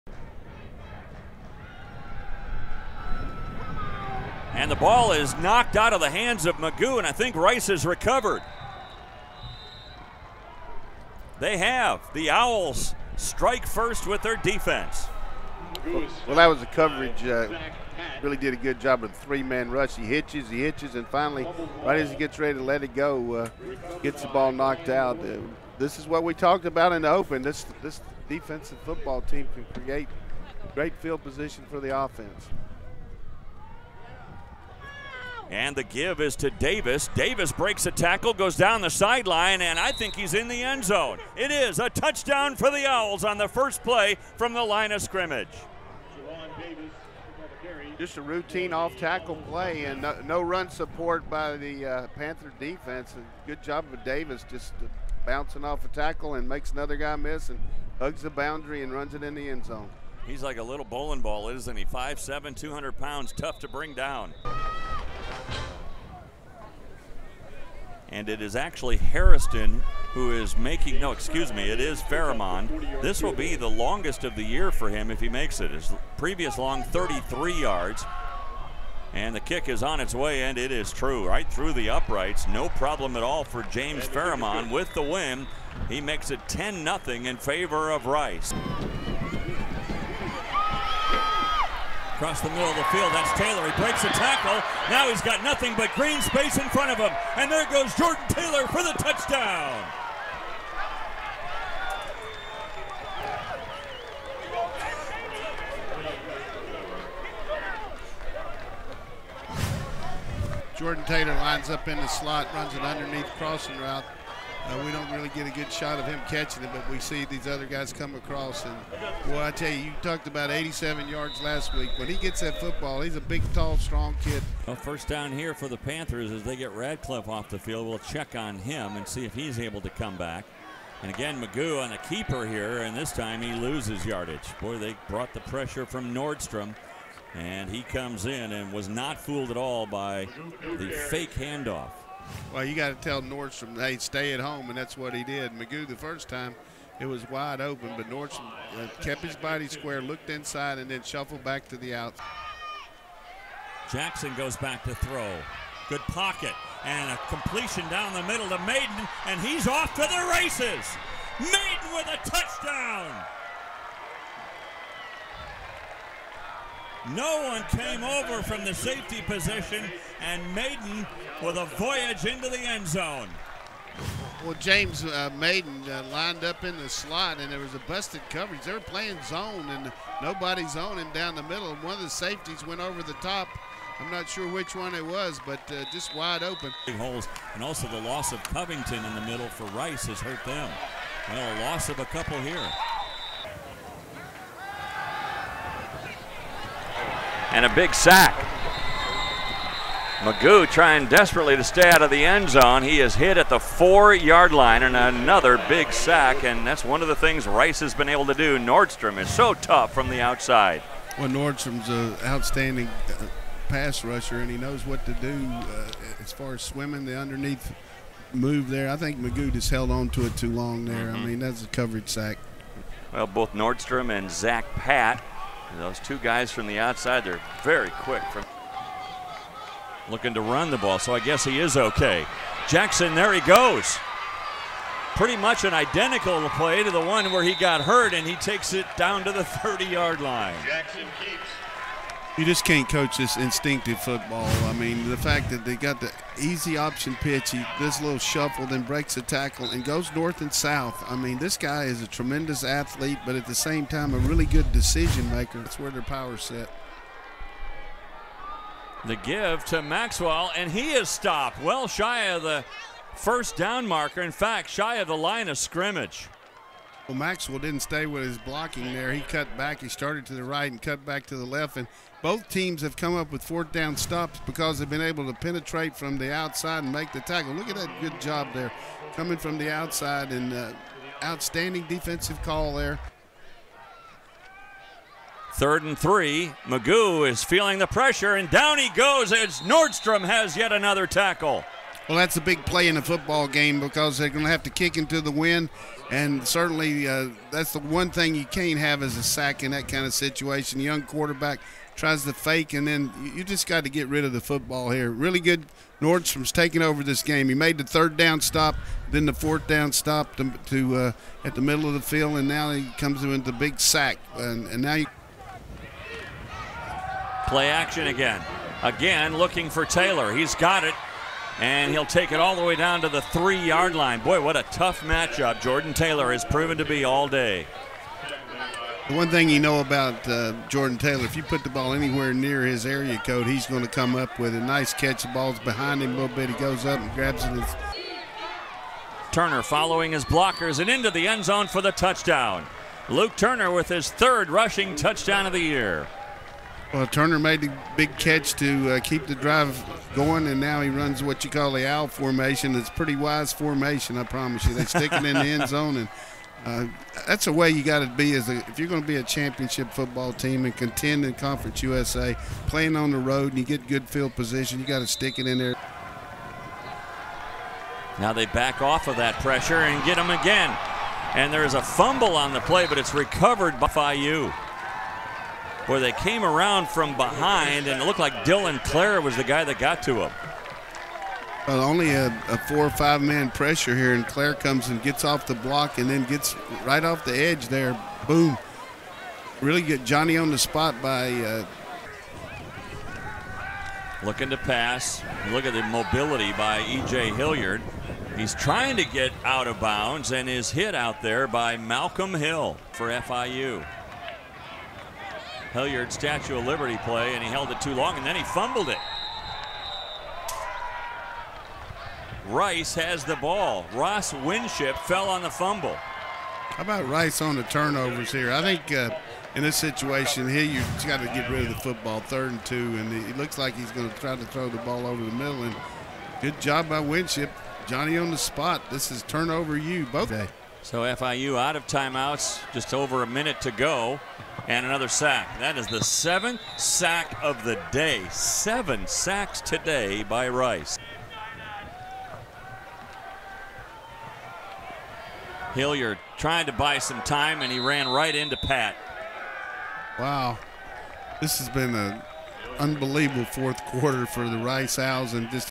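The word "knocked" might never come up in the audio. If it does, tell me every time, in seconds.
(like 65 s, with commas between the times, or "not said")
5 s, 24 s.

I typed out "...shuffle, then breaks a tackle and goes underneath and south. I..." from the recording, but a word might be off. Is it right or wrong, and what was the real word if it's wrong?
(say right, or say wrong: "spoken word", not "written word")
wrong: "north", not "underneath".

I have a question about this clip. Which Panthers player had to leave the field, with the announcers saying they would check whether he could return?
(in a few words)
Radcliffe.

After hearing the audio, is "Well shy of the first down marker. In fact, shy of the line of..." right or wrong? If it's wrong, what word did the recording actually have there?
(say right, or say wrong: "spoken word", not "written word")
right.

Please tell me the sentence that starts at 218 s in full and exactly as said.
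I think McGough just held on to it too long there.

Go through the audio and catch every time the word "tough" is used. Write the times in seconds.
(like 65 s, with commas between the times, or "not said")
63 s, 209 s, 324 s.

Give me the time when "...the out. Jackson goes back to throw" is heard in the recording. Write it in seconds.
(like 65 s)
151 s.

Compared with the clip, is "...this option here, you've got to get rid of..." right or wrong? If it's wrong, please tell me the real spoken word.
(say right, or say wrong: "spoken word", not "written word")
wrong: "situation", not "option".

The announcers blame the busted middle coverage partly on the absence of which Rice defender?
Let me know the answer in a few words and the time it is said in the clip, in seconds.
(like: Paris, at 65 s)
Covington, at 188 s.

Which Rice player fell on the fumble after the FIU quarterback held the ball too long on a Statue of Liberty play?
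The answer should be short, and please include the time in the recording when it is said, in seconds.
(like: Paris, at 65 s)
Ross Winship, at 413 s.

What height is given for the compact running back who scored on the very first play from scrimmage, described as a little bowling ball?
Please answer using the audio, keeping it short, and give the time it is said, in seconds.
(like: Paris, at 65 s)
5'7, at 61 s.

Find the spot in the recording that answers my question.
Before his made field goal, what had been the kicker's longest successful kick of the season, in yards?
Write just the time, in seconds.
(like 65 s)
76 s.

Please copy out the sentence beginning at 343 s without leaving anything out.
Luke Turner with his third rushing touchdown of the year.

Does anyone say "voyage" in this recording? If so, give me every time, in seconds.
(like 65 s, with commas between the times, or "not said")
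171 s.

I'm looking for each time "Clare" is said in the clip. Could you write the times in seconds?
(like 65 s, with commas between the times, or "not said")
378 s, 384 s.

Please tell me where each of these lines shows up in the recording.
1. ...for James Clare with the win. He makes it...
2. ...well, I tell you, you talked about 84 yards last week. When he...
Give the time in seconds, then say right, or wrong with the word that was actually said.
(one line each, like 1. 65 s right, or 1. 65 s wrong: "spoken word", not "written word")
1. 83 s wrong: "Farrimond", not "Clare"
2. 119 s wrong: "87", not "84".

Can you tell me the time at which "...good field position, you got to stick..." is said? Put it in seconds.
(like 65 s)
363 s.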